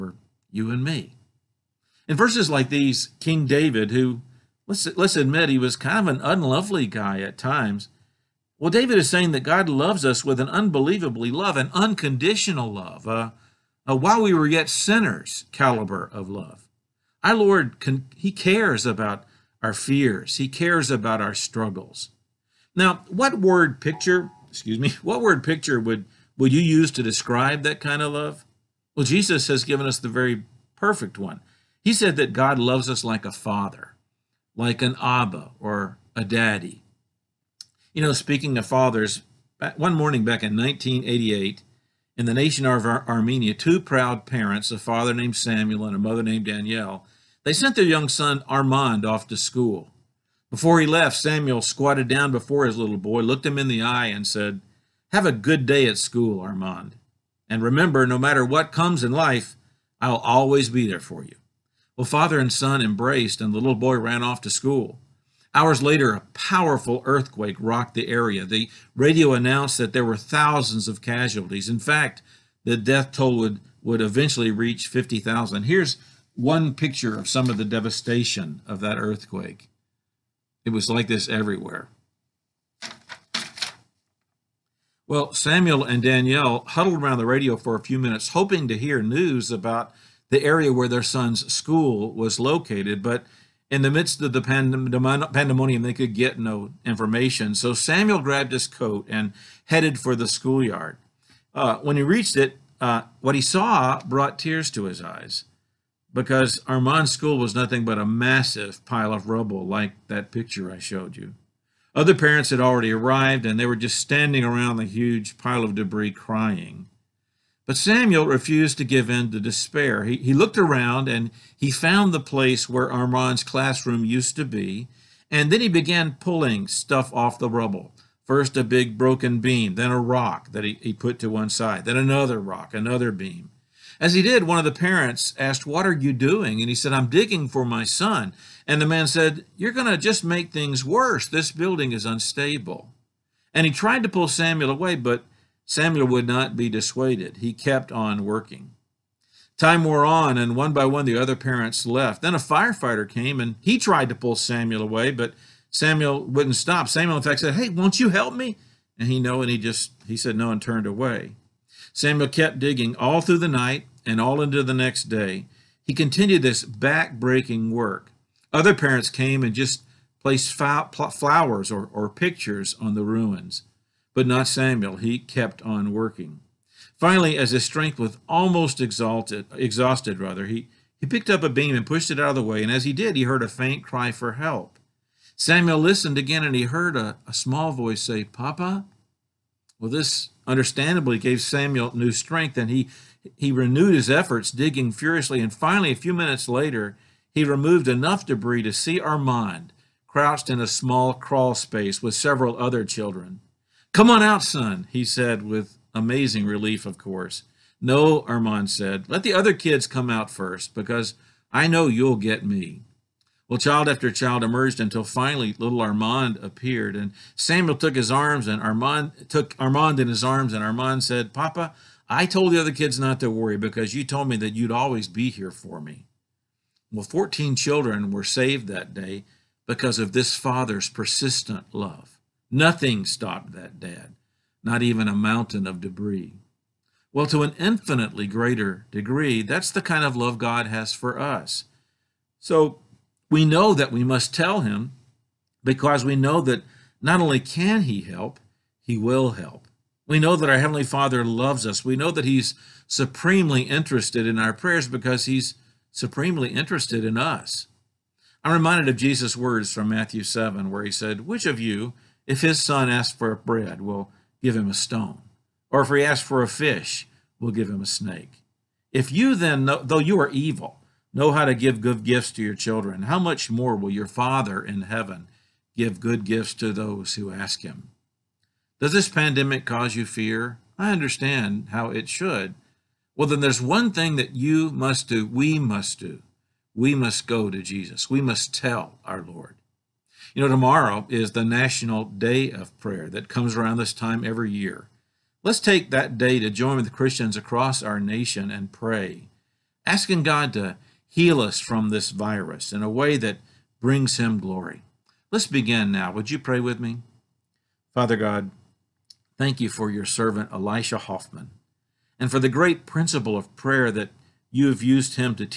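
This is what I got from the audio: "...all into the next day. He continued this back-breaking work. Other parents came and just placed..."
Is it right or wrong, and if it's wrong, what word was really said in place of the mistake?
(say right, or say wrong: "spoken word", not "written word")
right.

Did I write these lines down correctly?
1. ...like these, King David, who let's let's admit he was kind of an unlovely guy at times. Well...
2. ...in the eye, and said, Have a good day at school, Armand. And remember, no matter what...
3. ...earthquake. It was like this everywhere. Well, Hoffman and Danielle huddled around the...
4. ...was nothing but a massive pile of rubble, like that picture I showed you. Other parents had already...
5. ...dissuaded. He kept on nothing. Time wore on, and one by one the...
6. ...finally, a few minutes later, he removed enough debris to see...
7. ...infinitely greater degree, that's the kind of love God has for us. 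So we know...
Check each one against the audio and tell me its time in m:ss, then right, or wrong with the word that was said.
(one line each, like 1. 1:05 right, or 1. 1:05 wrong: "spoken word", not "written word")
1. 0:02 right
2. 0:53 right
3. 1:18 wrong: "Samuel", not "Hoffman"
4. 1:47 right
5. 2:26 wrong: "working", not "nothing"
6. 3:15 right
7. 3:57 right.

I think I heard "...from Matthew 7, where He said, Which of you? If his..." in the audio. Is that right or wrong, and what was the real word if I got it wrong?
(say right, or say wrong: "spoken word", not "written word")
right.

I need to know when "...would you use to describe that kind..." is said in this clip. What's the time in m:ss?
0:26.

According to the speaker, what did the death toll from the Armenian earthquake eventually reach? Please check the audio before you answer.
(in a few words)
50,000.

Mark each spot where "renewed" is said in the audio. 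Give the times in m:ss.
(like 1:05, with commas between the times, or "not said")
3:13.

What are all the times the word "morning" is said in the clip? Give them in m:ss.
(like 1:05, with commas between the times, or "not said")
0:39.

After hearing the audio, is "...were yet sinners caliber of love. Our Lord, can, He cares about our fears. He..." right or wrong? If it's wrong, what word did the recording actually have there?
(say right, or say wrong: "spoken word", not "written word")
right.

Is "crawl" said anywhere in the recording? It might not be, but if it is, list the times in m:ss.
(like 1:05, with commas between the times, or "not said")
3:21.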